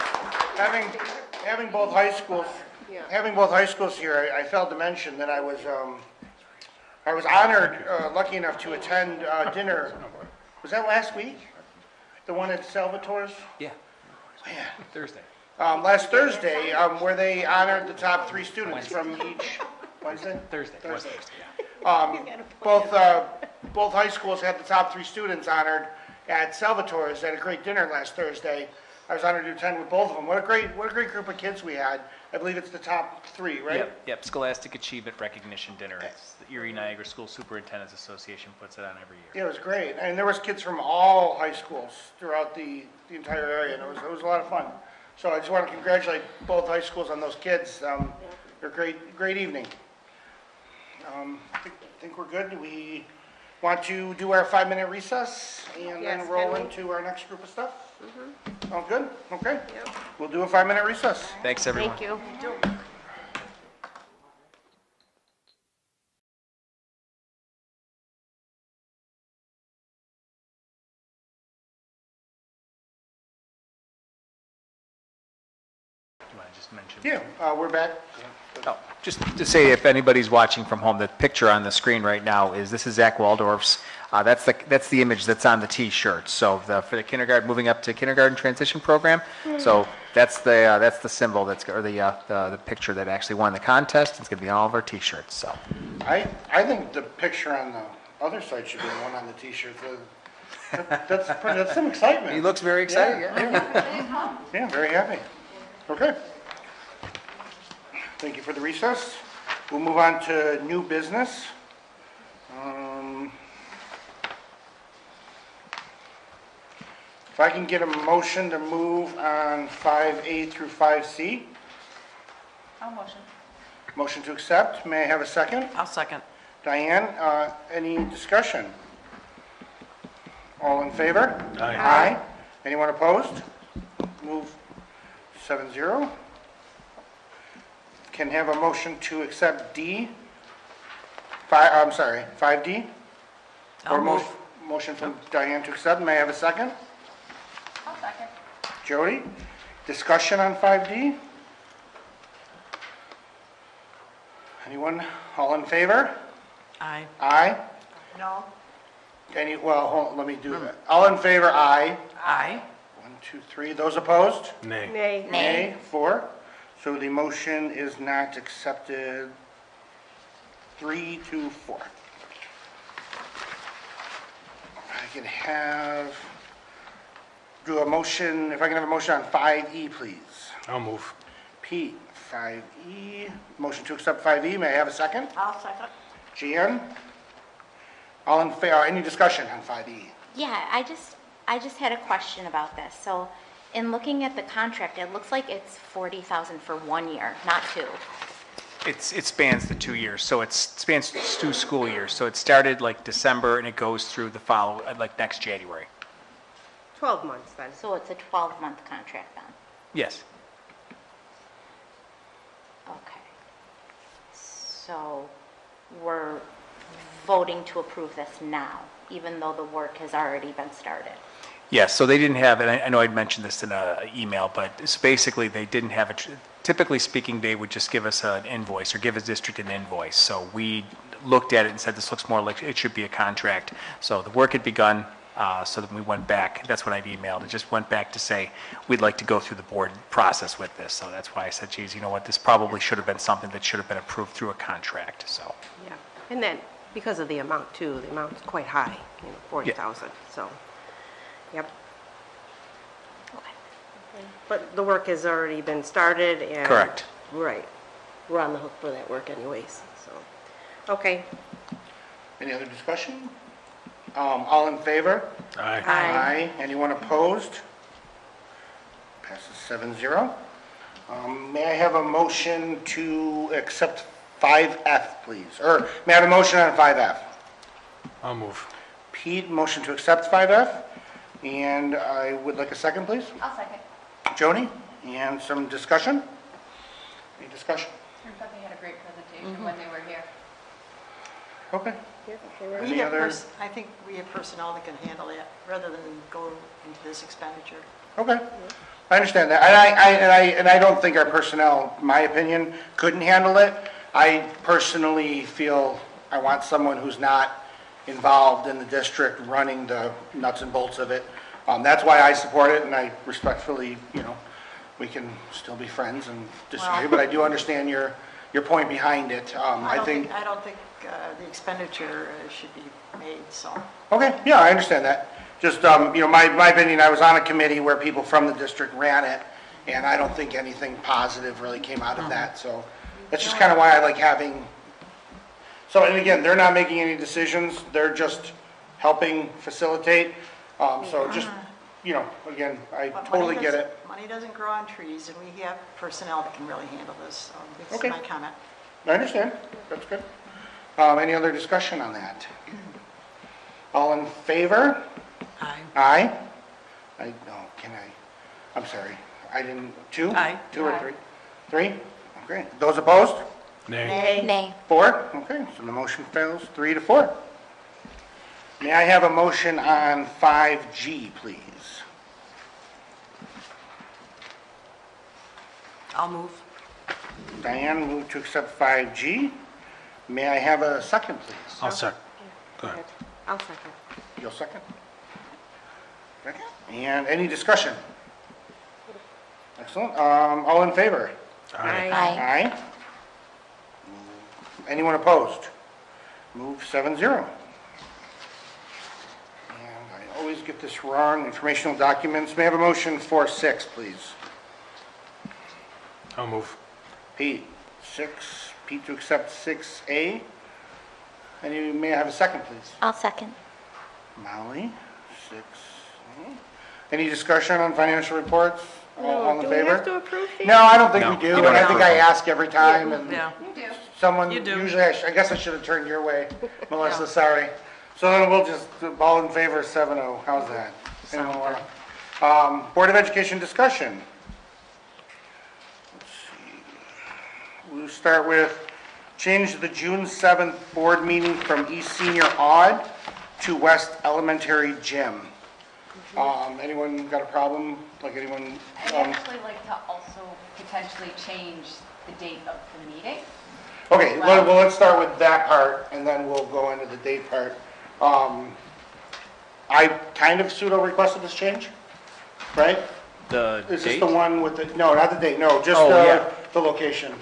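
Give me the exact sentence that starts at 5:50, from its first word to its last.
Um, any other discussion on that?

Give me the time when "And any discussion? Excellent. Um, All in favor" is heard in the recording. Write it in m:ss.
6:26.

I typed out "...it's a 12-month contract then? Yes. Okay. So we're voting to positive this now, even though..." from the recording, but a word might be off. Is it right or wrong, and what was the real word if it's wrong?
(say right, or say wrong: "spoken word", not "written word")
wrong: "approve", not "positive".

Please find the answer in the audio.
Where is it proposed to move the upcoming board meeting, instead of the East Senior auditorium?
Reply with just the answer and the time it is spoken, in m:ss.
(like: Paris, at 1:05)
West Elementary Gym, at 7:23.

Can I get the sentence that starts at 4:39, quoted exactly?
Pete, motion to accept five F, and I would like a second, please.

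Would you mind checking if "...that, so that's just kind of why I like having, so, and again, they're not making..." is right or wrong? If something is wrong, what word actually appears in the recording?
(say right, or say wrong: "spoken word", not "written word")
right.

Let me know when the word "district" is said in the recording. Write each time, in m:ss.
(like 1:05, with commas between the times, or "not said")
3:49, 5:08, 5:28.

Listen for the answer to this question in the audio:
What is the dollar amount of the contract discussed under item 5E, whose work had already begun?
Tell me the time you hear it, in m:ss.
3:15.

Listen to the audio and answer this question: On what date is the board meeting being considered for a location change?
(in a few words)
June 7th.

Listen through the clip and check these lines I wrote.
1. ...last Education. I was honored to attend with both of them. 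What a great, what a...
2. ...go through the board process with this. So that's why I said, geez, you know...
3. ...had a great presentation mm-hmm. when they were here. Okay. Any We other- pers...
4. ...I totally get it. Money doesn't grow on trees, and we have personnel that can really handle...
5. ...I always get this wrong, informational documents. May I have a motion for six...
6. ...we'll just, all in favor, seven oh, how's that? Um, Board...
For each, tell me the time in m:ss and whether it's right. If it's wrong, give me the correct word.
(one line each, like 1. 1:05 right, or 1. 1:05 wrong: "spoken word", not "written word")
1. 0:27 wrong: "Thursday", not "Education"
2. 3:59 right
3. 4:48 right
4. 5:42 right
5. 6:39 right
6. 7:08 right.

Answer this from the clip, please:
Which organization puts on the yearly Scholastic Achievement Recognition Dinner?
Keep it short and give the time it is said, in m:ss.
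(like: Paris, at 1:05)
Erie Niagara School Superintendent's Association, at 0:36.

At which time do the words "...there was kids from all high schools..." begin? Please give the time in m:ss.
0:40.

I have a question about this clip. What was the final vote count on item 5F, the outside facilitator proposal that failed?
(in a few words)
3 to 4.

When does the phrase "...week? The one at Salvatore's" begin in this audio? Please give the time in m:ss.
0:11.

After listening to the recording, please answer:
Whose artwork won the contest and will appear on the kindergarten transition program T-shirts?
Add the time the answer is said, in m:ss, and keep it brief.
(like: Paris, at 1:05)
Zach Waldorf, at 1:22.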